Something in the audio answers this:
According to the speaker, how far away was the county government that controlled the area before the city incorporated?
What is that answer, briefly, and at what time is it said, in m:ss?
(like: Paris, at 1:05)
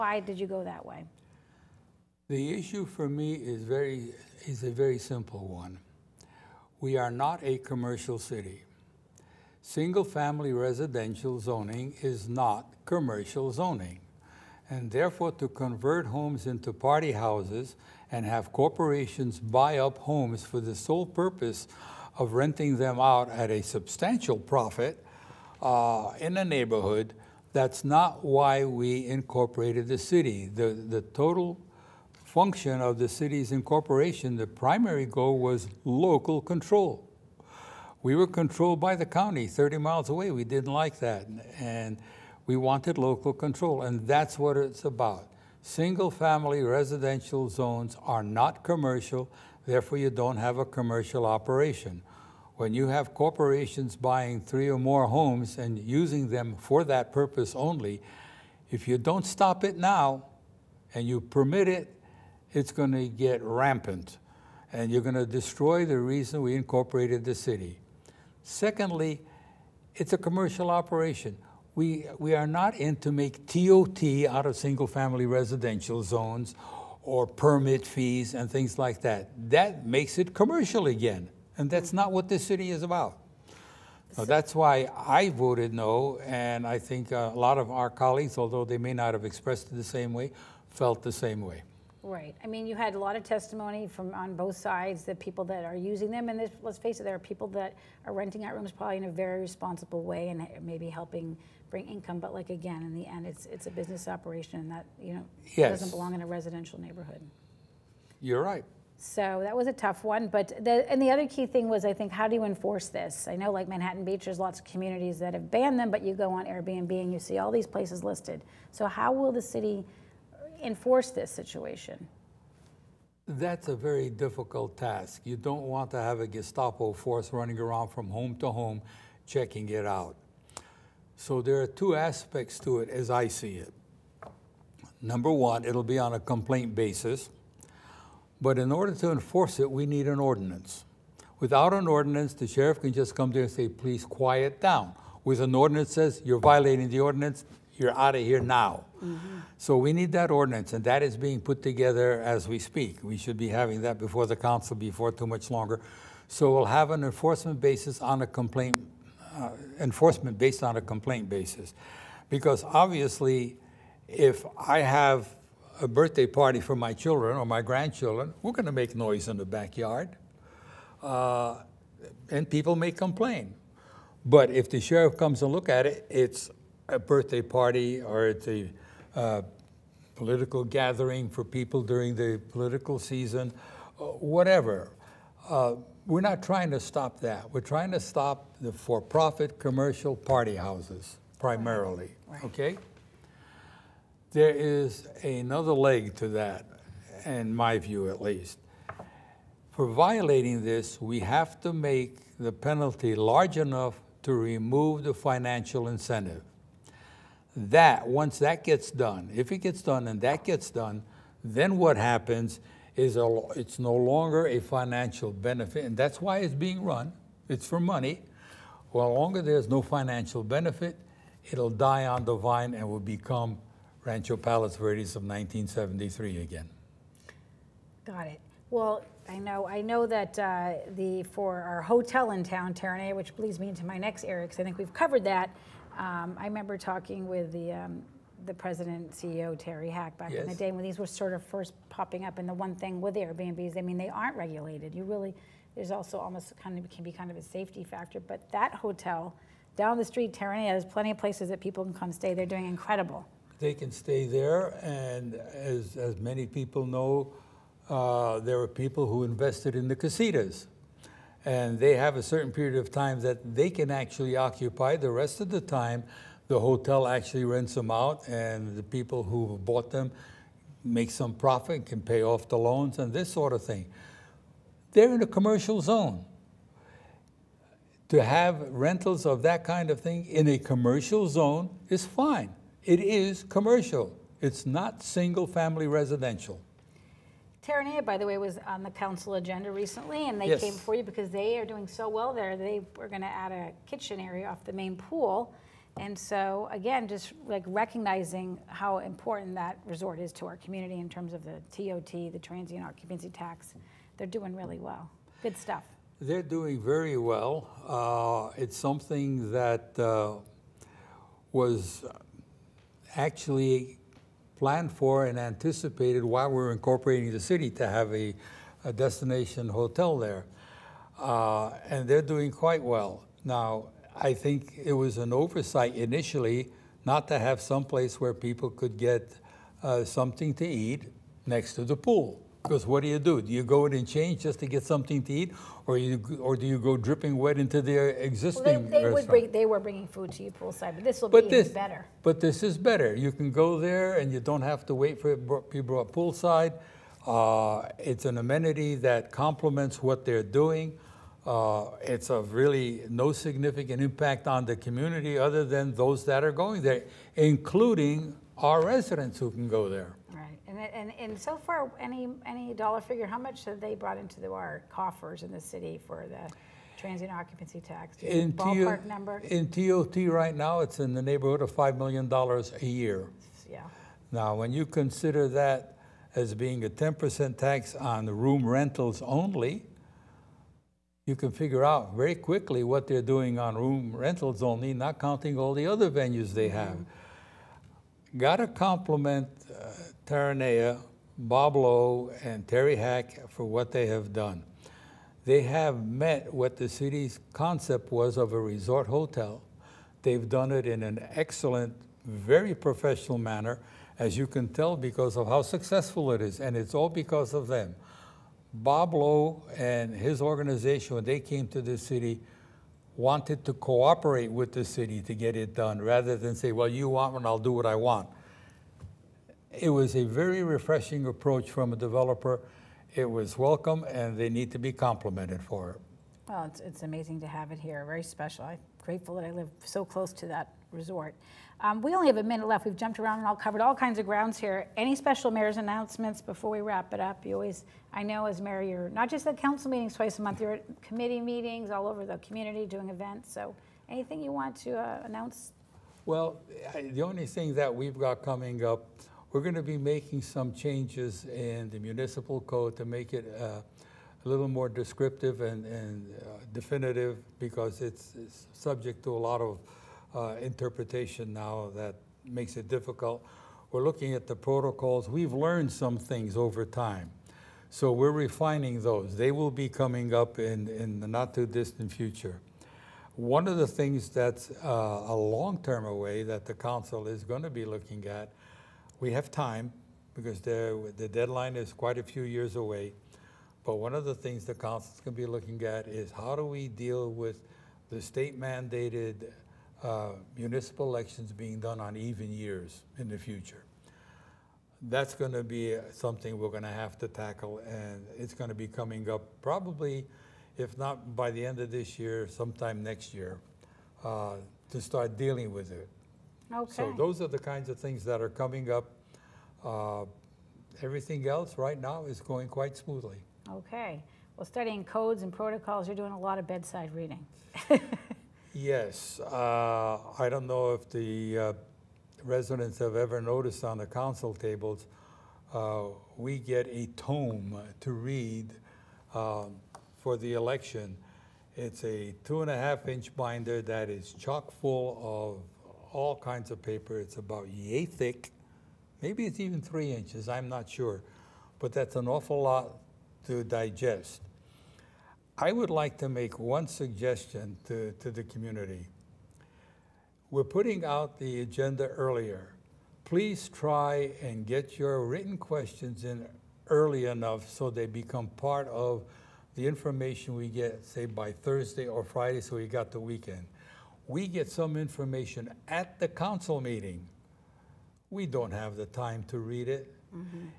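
30 miles, at 0:39.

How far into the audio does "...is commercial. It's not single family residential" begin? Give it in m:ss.
4:42.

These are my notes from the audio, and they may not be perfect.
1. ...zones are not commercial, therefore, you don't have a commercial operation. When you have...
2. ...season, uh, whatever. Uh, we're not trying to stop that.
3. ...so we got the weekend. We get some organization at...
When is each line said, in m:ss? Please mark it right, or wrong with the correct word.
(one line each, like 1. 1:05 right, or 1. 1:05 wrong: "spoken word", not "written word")
1. 0:47 right
2. 3:02 right
3. 9:22 wrong: "information", not "organization".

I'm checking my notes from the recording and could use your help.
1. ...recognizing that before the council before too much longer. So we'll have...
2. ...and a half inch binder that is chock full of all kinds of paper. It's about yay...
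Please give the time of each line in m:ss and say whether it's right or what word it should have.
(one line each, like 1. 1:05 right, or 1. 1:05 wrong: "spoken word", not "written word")
1. 2:33 wrong: "having", not "recognizing"
2. 8:52 right.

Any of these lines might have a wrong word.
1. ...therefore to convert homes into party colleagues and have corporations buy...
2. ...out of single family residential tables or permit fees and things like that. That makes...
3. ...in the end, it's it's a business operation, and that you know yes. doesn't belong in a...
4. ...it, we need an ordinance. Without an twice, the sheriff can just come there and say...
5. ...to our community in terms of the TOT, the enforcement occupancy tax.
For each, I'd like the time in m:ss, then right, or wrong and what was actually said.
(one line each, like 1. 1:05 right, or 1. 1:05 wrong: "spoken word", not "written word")
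1. 0:14 wrong: "houses", not "colleagues"
2. 1:14 wrong: "zones", not "tables"
3. 1:42 right
4. 2:19 wrong: "ordinance", not "twice"
5. 5:00 wrong: "transient", not "enforcement".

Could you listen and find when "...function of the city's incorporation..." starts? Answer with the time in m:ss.
0:32.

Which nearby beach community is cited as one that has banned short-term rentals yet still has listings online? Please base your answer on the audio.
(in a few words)
Manhattan Beach.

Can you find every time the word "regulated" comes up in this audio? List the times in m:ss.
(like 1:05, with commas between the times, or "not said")
4:04.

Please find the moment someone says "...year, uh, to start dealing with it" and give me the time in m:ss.
8:23.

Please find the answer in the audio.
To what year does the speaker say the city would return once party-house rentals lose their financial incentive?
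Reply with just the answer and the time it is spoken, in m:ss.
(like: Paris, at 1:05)
1973, at 3:45.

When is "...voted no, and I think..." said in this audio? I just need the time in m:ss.
1:25.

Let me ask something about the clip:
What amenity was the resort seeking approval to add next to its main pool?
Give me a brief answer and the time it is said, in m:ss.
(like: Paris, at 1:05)
a kitchen area, at 4:53.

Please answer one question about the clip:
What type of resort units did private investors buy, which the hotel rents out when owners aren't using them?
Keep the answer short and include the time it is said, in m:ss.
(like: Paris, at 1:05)
casitas, at 4:19.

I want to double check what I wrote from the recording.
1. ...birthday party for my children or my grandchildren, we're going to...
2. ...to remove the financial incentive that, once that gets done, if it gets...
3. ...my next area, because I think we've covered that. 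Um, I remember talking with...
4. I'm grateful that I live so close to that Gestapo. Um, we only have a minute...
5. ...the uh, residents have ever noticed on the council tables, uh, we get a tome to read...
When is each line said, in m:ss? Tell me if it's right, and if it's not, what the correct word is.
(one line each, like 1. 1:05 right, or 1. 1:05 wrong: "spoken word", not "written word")
1. 2:45 right
2. 3:24 right
3. 3:53 right
4. 7:08 wrong: "Resort", not "Gestapo"
5. 8:41 right.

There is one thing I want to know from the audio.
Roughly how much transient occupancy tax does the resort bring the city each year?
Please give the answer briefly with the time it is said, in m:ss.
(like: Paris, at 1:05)
$5 million, at 6:11.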